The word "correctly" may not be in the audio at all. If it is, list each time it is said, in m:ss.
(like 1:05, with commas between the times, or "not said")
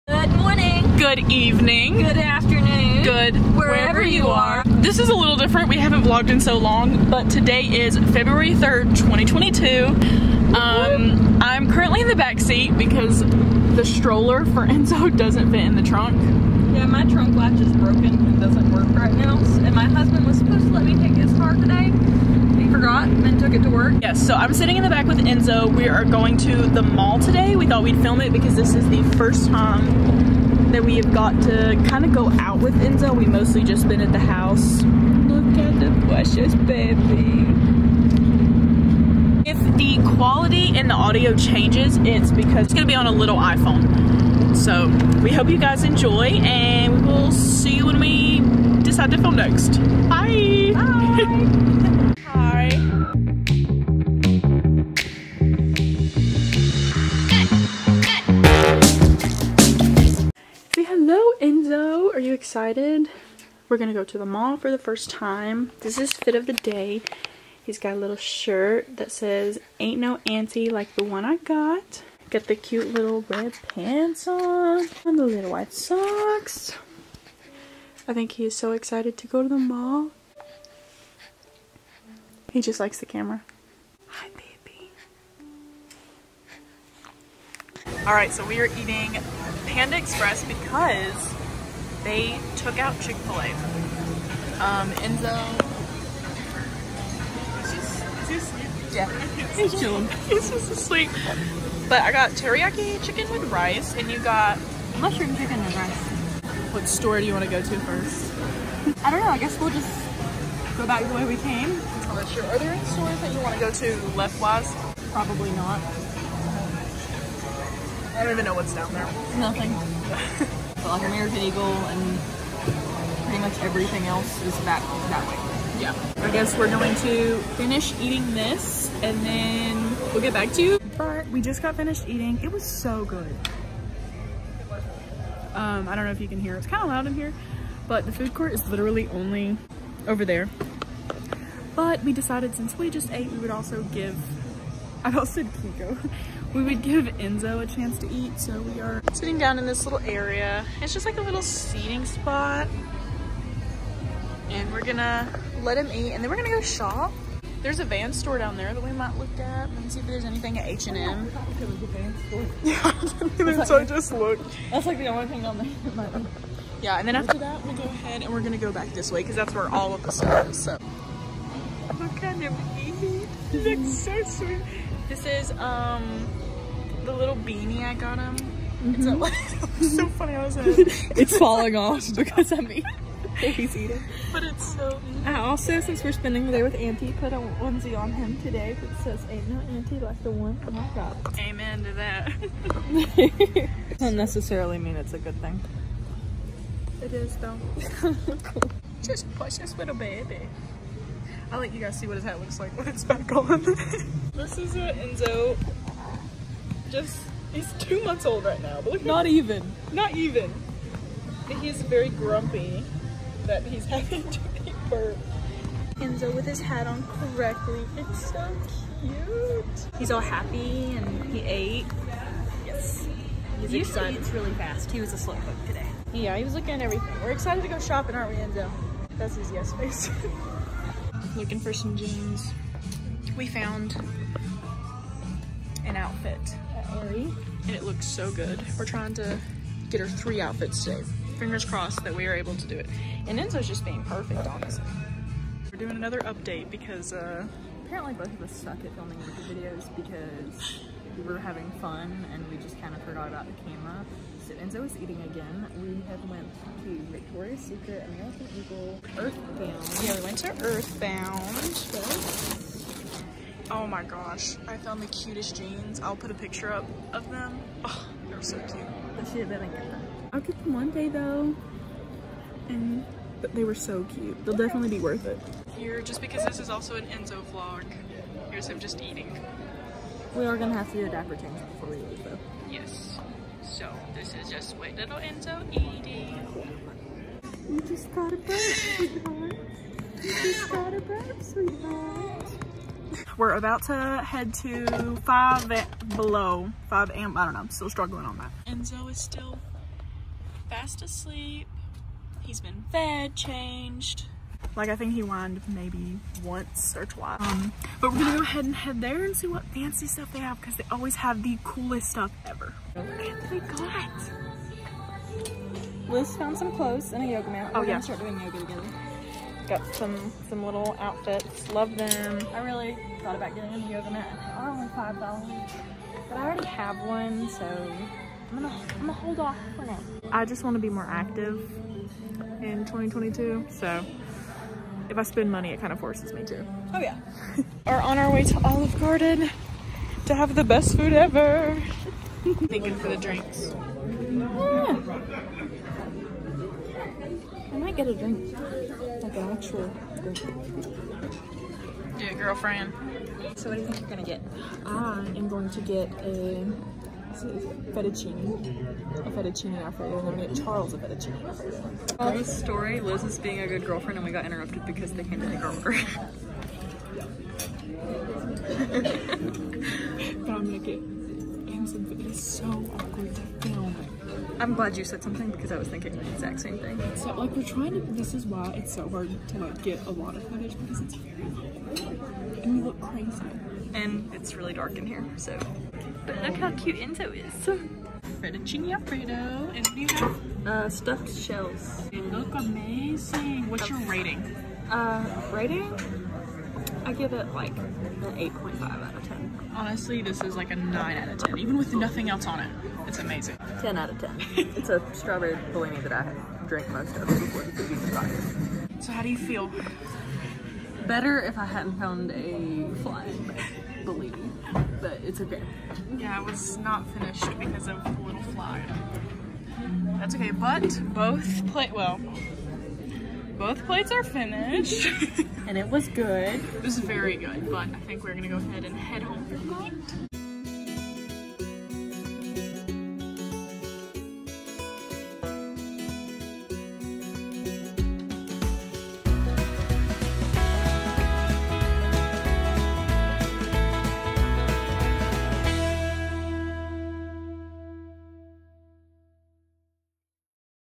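3:37.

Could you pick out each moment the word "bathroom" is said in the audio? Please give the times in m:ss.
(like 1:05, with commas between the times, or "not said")
not said.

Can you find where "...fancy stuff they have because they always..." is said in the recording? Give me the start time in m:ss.
5:09.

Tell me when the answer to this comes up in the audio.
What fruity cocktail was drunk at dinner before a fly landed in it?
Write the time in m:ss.
6:45.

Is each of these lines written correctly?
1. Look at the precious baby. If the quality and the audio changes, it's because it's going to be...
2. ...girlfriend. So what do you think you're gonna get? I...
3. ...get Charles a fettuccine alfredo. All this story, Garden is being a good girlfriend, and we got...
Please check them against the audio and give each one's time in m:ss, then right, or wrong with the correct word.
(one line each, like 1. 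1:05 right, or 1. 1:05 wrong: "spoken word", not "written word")
1. 0:34 right
2. 5:52 right
3. 6:00 wrong: "Liz", not "Garden".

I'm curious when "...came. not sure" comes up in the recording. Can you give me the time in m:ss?
1:51.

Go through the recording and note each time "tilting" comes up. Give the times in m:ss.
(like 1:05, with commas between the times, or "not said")
not said.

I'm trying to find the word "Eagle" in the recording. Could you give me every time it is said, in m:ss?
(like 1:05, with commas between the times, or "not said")
2:01, 4:18.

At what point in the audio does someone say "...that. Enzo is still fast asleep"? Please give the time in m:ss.
4:58.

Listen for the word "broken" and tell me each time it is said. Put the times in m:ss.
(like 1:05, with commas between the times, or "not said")
0:17.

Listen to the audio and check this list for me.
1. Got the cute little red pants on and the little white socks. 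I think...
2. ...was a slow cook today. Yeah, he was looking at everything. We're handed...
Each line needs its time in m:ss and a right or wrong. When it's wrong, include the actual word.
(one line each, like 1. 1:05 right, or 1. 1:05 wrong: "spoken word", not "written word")
1. 1:12 right
2. 3:45 wrong: "excited", not "handed".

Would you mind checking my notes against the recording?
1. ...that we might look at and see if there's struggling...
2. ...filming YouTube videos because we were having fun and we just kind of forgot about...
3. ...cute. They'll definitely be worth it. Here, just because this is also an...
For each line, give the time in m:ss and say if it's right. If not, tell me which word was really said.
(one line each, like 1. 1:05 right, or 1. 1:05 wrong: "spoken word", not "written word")
1. 2:38 wrong: "anything", not "struggling"
2. 4:08 right
3. 4:34 right.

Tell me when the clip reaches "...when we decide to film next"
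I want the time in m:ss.
0:47.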